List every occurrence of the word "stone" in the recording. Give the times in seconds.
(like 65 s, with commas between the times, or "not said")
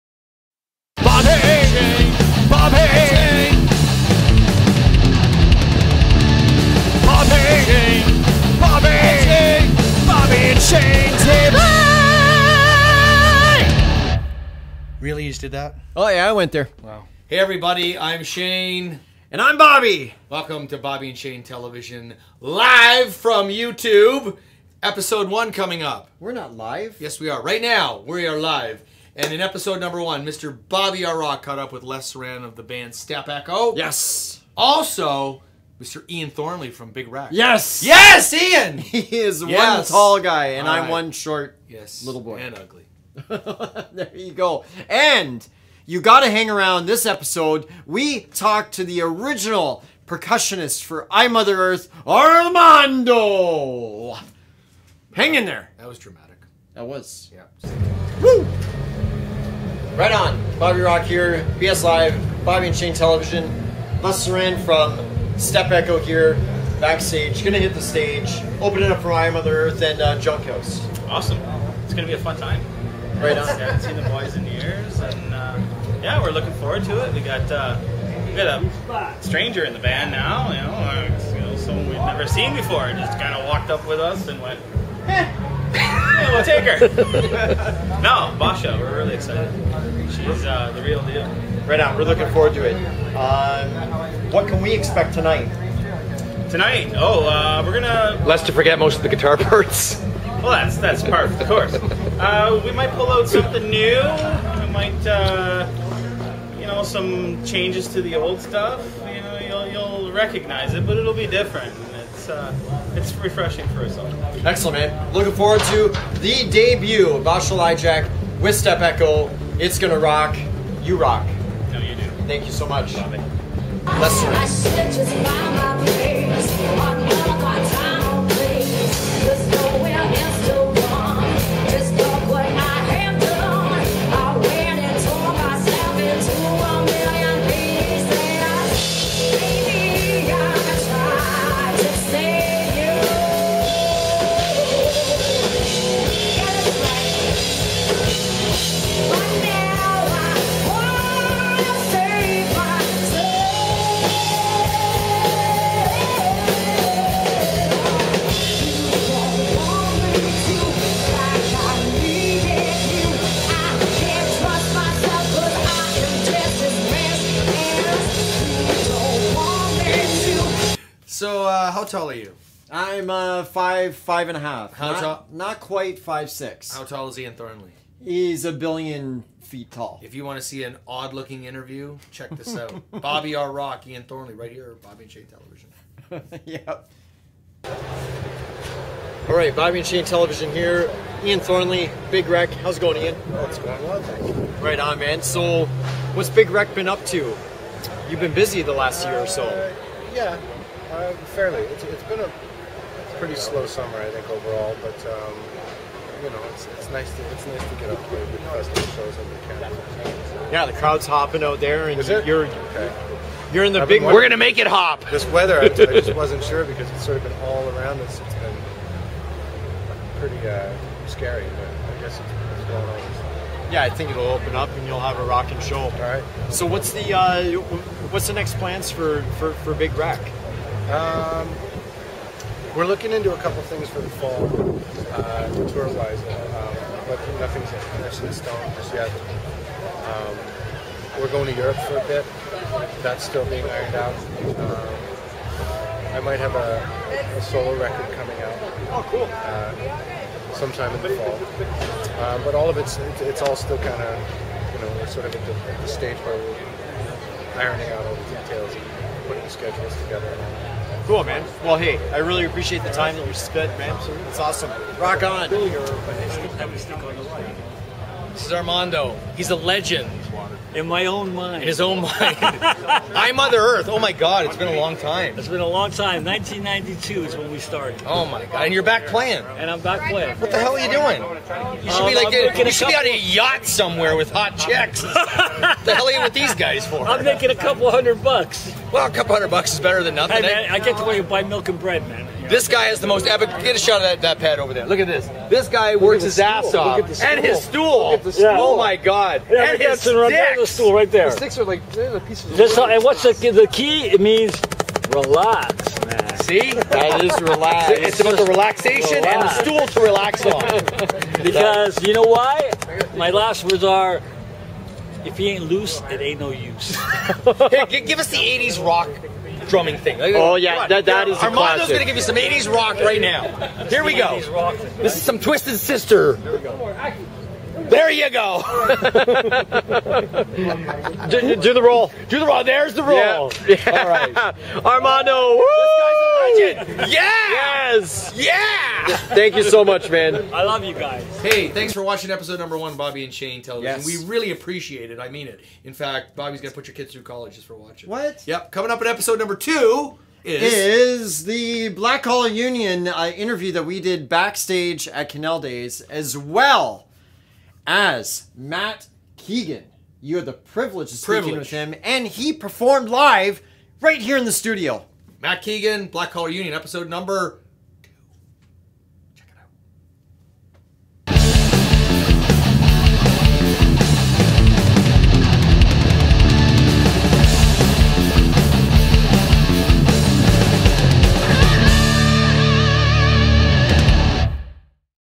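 238 s.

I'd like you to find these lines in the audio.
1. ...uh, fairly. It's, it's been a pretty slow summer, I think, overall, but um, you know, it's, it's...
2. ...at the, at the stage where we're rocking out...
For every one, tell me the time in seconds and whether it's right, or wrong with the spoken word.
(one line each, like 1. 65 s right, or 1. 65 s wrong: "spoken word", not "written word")
1. 200 s right
2. 255 s wrong: "ironing", not "rocking".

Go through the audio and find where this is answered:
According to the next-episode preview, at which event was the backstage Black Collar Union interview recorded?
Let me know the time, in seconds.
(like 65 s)
355 s.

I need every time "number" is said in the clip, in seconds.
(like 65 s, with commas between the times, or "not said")
29 s, 342 s, 349 s, 367 s.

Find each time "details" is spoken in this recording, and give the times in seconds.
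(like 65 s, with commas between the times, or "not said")
258 s.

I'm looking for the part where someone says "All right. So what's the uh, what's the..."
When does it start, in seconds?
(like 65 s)
225 s.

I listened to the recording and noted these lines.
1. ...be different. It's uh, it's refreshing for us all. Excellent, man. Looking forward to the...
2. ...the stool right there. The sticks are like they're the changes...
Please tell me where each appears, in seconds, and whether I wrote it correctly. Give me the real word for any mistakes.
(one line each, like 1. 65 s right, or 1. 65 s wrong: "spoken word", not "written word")
1. 111 s right
2. 300 s wrong: "pieces", not "changes".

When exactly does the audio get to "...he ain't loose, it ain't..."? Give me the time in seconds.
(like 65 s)
315 s.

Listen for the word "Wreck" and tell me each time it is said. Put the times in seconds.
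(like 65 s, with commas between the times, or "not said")
37 s, 192 s, 196 s, 229 s.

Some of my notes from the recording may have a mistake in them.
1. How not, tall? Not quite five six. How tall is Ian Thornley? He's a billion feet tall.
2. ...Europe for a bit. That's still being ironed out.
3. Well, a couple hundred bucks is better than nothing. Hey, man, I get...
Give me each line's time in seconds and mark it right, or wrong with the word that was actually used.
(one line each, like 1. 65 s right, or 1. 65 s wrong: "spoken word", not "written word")
1. 174 s right
2. 241 s right
3. 288 s right.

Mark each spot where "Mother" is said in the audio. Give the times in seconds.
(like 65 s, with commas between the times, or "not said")
51 s, 69 s, 273 s.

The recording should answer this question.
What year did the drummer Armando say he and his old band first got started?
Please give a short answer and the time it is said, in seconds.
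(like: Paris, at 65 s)
1992, at 276 s.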